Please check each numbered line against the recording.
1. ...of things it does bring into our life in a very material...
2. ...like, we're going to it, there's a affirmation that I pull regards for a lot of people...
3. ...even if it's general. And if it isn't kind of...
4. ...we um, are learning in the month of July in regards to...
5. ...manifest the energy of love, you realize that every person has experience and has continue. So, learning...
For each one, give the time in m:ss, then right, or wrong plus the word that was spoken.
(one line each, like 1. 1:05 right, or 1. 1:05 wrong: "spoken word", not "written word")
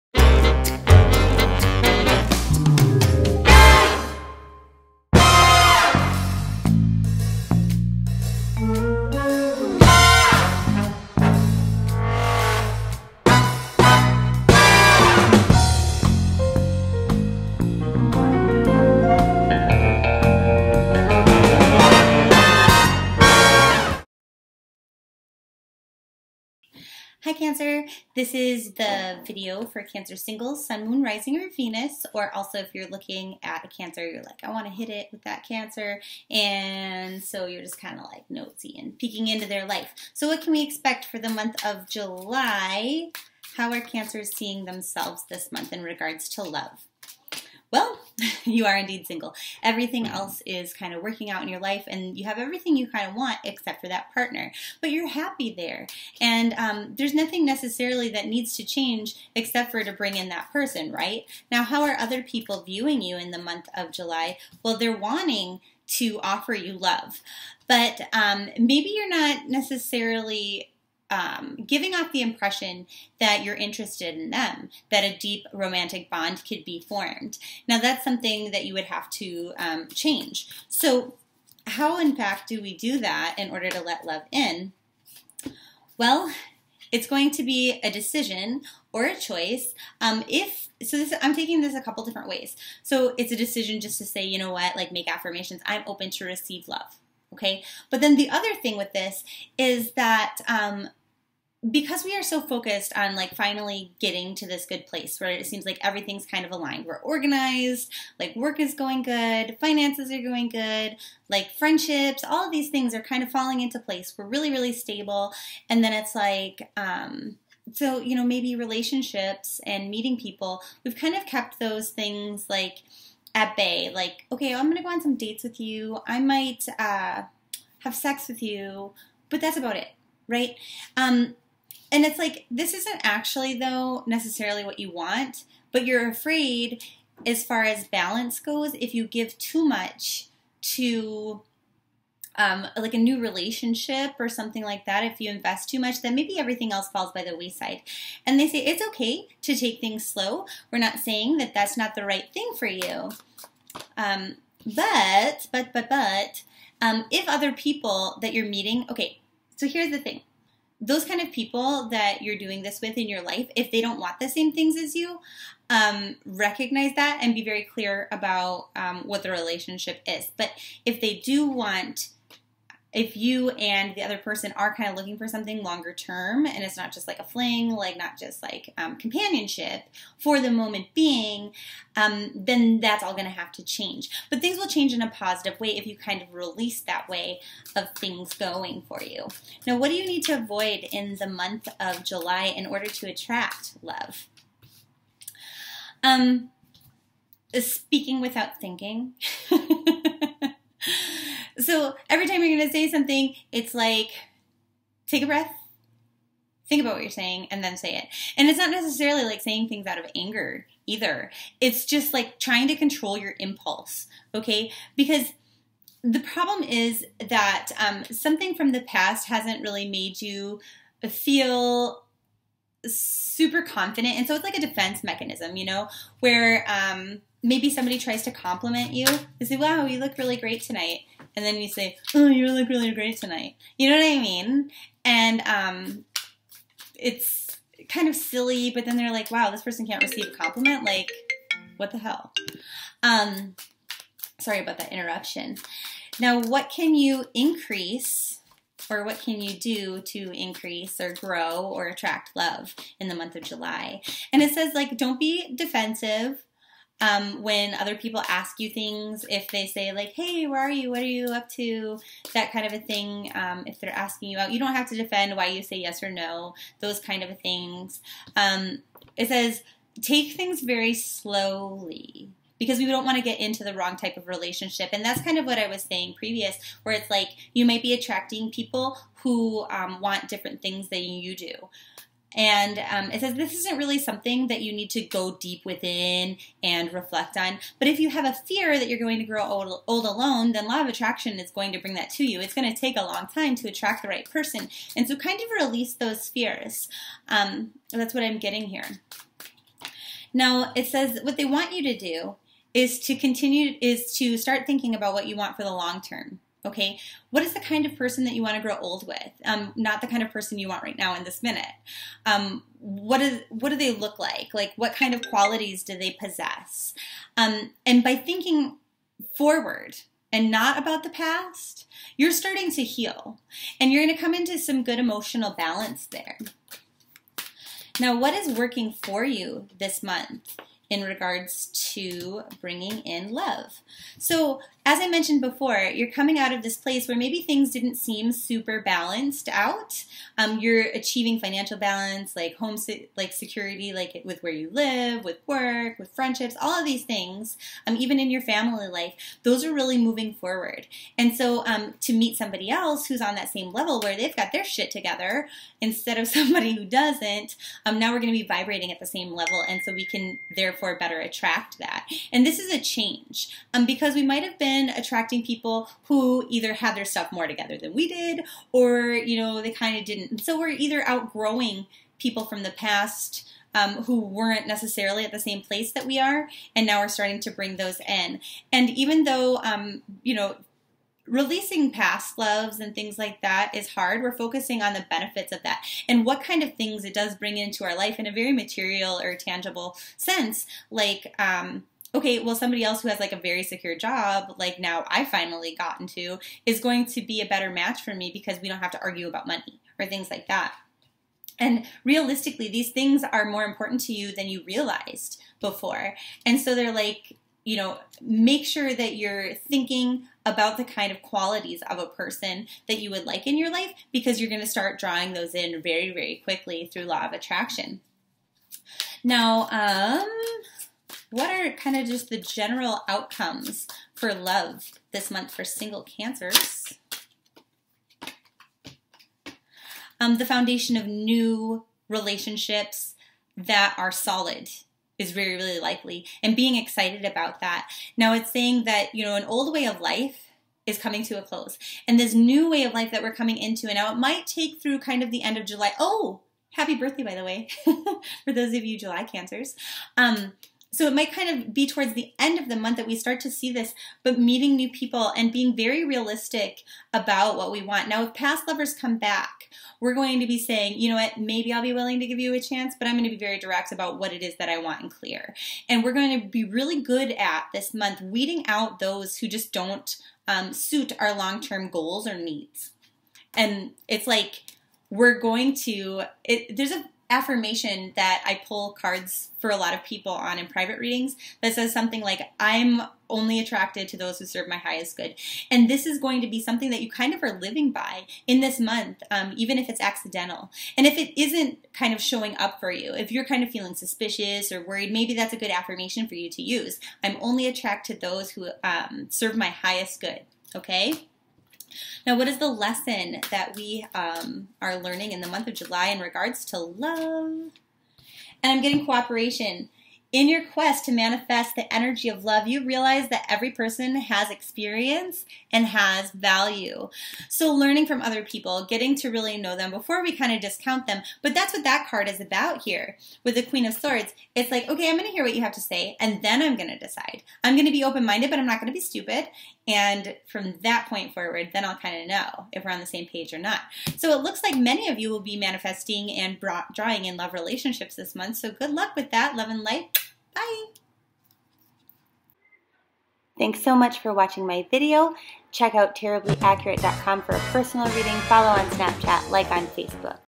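1. 6:26 right
2. 7:54 wrong: "cards", not "regards"
3. 8:09 wrong: "accidental", not "general"
4. 8:23 right
5. 8:31 wrong: "value", not "continue".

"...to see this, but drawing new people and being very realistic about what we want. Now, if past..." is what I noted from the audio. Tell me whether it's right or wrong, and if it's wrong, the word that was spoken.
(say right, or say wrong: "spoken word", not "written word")
wrong: "meeting", not "drawing".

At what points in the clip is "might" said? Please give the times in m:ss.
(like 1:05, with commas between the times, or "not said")
2:06, 4:37, 6:04, 7:24, 7:31.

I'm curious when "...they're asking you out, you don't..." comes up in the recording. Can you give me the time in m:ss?
4:23.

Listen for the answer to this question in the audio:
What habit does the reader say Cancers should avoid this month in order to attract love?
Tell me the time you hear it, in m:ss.
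3:17.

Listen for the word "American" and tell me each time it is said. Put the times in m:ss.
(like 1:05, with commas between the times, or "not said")
not said.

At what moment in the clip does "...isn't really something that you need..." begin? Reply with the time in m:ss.
4:43.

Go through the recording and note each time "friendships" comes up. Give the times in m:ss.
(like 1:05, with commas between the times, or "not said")
1:51, 5:46.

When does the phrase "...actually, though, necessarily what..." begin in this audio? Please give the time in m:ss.
2:13.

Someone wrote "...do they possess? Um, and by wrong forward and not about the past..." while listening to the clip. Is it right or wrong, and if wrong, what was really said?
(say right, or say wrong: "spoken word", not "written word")
wrong: "thinking", not "wrong".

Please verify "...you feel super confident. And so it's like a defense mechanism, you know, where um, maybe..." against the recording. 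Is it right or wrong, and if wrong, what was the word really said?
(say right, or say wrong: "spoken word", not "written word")
right.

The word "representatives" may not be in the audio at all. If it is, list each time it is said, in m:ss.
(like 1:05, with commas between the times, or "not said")
not said.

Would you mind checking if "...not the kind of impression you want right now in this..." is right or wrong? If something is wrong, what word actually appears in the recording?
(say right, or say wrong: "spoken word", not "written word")
wrong: "person", not "impression".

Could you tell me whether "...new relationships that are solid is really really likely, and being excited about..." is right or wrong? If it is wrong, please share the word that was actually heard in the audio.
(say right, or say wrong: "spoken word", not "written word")
right.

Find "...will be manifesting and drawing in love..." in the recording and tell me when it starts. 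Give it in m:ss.
8:55.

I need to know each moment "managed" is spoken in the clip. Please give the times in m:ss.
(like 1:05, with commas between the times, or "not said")
not said.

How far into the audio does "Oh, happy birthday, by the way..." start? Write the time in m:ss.
7:25.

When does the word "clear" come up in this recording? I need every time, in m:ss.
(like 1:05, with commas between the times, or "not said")
2:47, 7:45.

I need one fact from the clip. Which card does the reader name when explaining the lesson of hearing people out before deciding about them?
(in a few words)
Queen of Swords.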